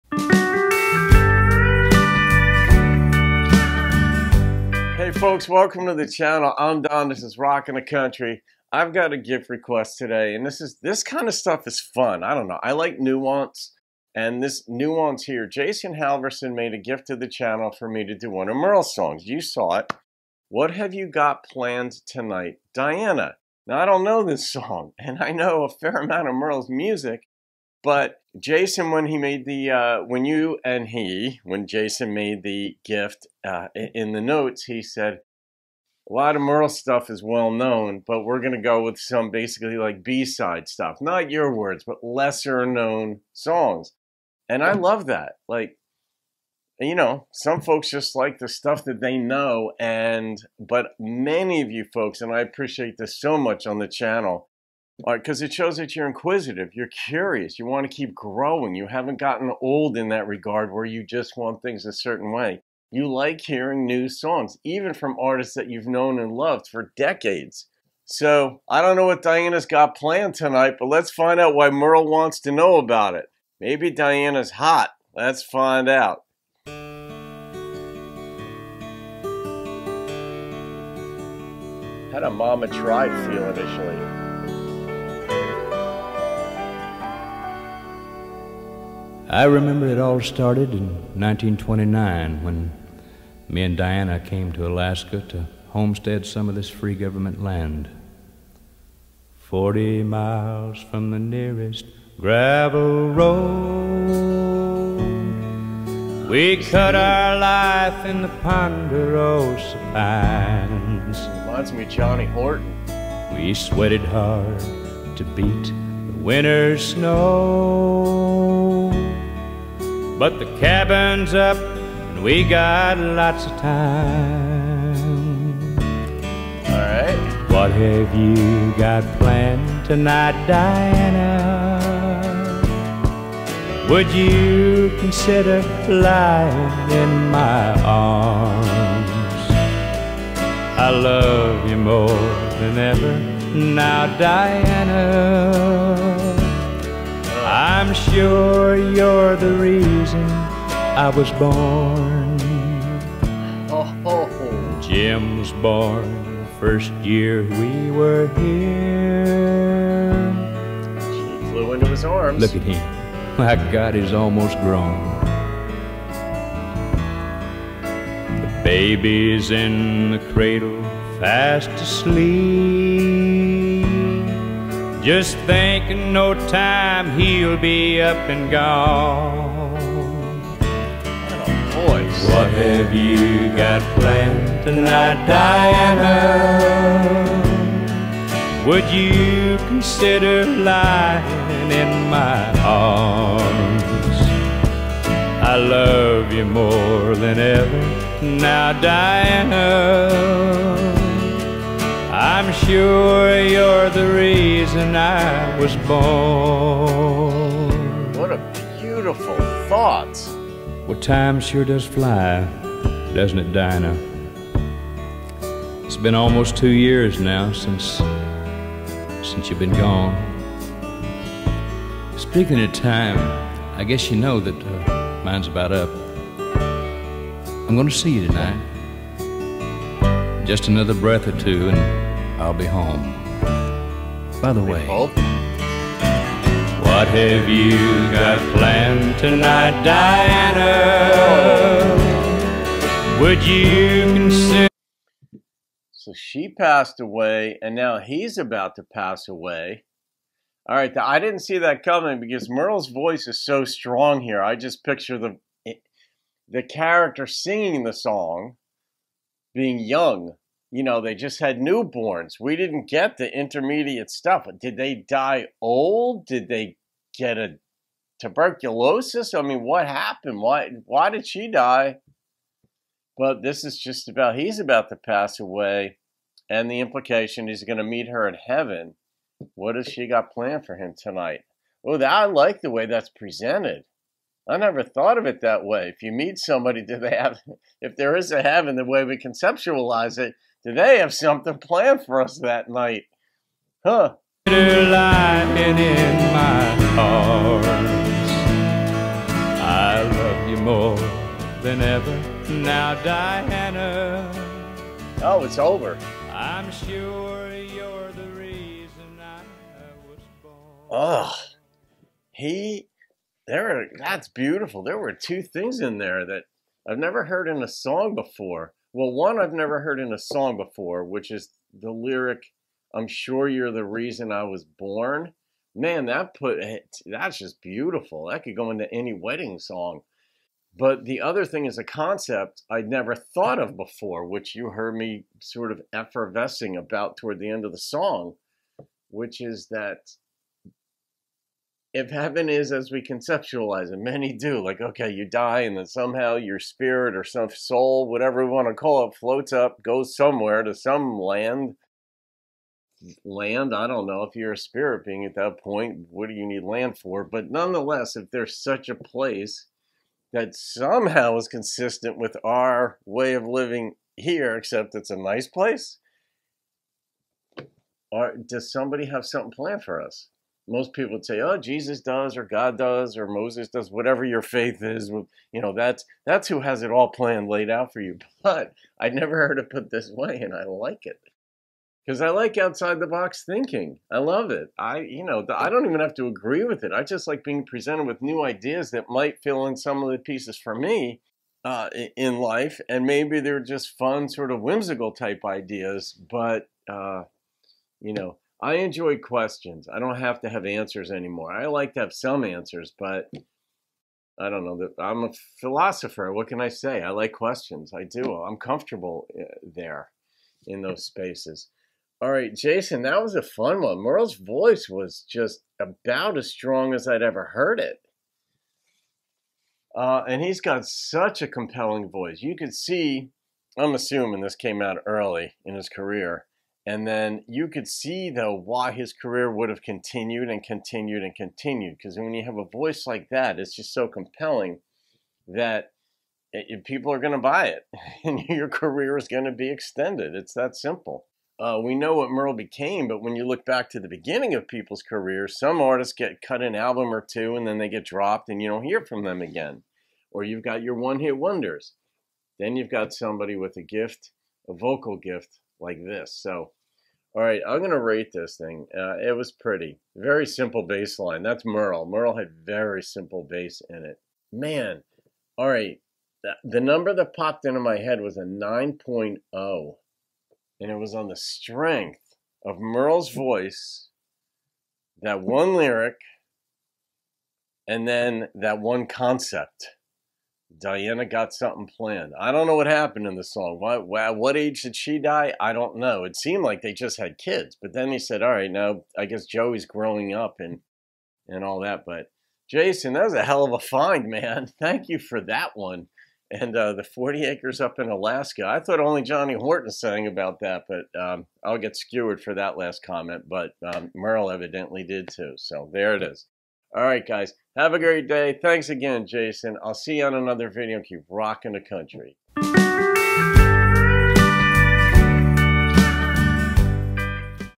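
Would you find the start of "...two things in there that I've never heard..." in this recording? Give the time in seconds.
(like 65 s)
315 s.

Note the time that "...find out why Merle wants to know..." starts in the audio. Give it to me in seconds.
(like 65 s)
71 s.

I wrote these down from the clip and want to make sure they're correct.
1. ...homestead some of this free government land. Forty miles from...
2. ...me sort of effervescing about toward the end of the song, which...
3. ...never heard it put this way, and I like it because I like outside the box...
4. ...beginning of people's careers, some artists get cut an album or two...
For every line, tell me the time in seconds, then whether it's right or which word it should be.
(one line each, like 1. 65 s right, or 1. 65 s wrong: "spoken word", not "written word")
1. 95 s right
2. 334 s right
3. 379 s right
4. 444 s right.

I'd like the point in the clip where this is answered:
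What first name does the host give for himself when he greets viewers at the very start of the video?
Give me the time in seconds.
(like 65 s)
6 s.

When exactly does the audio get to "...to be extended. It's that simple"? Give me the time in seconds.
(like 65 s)
439 s.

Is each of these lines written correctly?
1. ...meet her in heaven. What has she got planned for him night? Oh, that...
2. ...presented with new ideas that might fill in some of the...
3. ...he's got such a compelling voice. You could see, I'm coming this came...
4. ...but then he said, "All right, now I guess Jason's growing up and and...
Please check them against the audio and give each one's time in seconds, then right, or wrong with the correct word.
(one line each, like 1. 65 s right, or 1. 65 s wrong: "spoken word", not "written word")
1. 277 s wrong: "tonight", not "night"
2. 387 s right
3. 420 s wrong: "assuming", not "coming"
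4. 487 s wrong: "Joey", not "Jason".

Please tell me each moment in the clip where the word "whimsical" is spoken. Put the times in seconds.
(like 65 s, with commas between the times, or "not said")
394 s.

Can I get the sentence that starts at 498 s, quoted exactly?
I thought only Johnny Horton sang about that, but um, I'll get skewered for that last comment.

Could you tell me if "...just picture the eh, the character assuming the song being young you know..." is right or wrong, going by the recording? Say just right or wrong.
wrong.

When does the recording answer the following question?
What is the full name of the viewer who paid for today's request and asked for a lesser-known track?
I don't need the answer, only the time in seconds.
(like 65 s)
15 s.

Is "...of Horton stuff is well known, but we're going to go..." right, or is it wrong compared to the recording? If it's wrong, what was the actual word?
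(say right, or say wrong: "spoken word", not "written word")
wrong: "Merle", not "Horton".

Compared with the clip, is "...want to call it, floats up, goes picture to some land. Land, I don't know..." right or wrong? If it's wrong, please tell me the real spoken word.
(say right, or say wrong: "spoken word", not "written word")
wrong: "somewhere", not "picture".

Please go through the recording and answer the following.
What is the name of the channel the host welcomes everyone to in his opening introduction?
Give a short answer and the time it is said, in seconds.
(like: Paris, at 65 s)
RockN2Country, at 7 s.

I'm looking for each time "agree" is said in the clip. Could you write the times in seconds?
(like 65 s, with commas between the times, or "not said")
386 s.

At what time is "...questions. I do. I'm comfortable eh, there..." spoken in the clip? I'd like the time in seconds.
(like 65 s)
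407 s.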